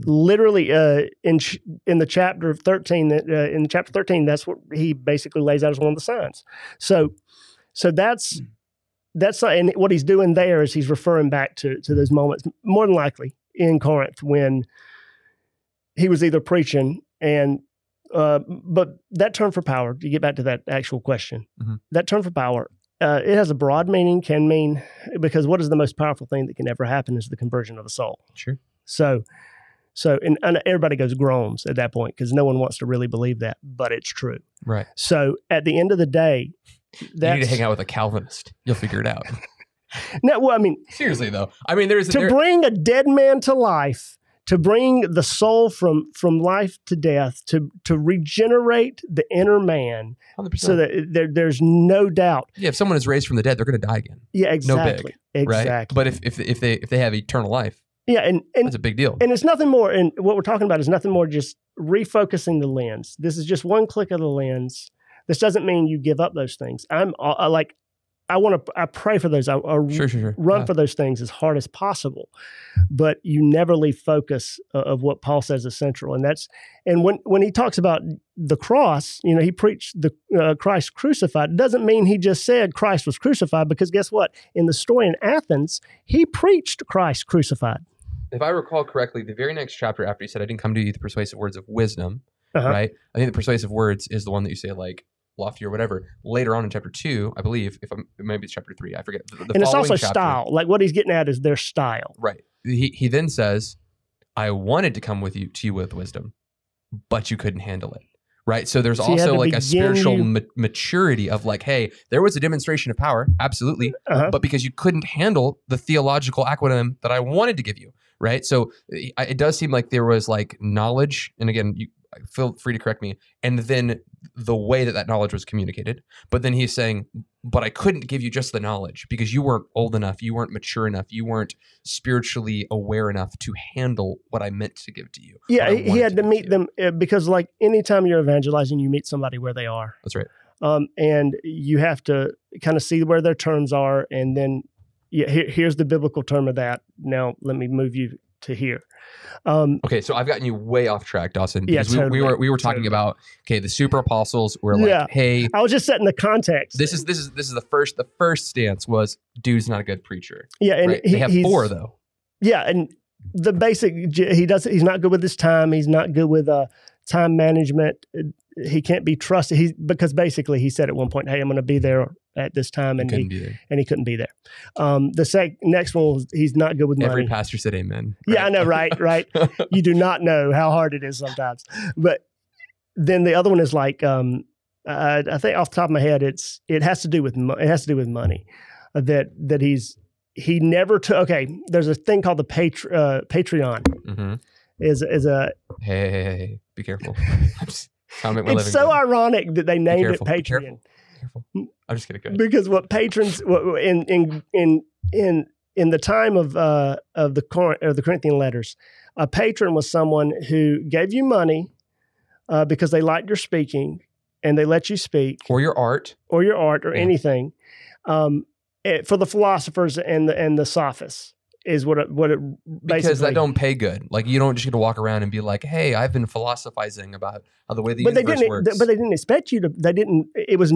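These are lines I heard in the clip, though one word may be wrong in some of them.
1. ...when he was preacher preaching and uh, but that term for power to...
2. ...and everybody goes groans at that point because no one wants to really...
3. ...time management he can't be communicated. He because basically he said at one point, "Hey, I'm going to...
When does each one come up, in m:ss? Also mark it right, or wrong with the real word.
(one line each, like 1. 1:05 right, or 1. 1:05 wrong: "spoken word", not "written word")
1. 0:14 wrong: "either", not "preacher"
2. 0:30 right
3. 2:47 wrong: "trusted", not "communicated".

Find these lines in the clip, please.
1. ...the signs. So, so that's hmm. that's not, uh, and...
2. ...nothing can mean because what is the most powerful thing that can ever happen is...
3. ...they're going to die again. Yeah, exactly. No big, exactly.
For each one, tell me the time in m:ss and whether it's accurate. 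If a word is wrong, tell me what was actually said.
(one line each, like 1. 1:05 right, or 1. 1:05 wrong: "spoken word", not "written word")
1. 0:05 right
2. 0:23 wrong: "meaning", not "nothing"
3. 0:53 right.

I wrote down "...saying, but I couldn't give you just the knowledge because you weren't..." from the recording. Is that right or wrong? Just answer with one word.
right.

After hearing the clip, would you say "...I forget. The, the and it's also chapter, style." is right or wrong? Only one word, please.
right.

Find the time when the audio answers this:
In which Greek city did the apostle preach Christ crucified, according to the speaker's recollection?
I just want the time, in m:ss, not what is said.
1:25.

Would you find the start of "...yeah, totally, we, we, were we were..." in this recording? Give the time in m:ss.
2:31.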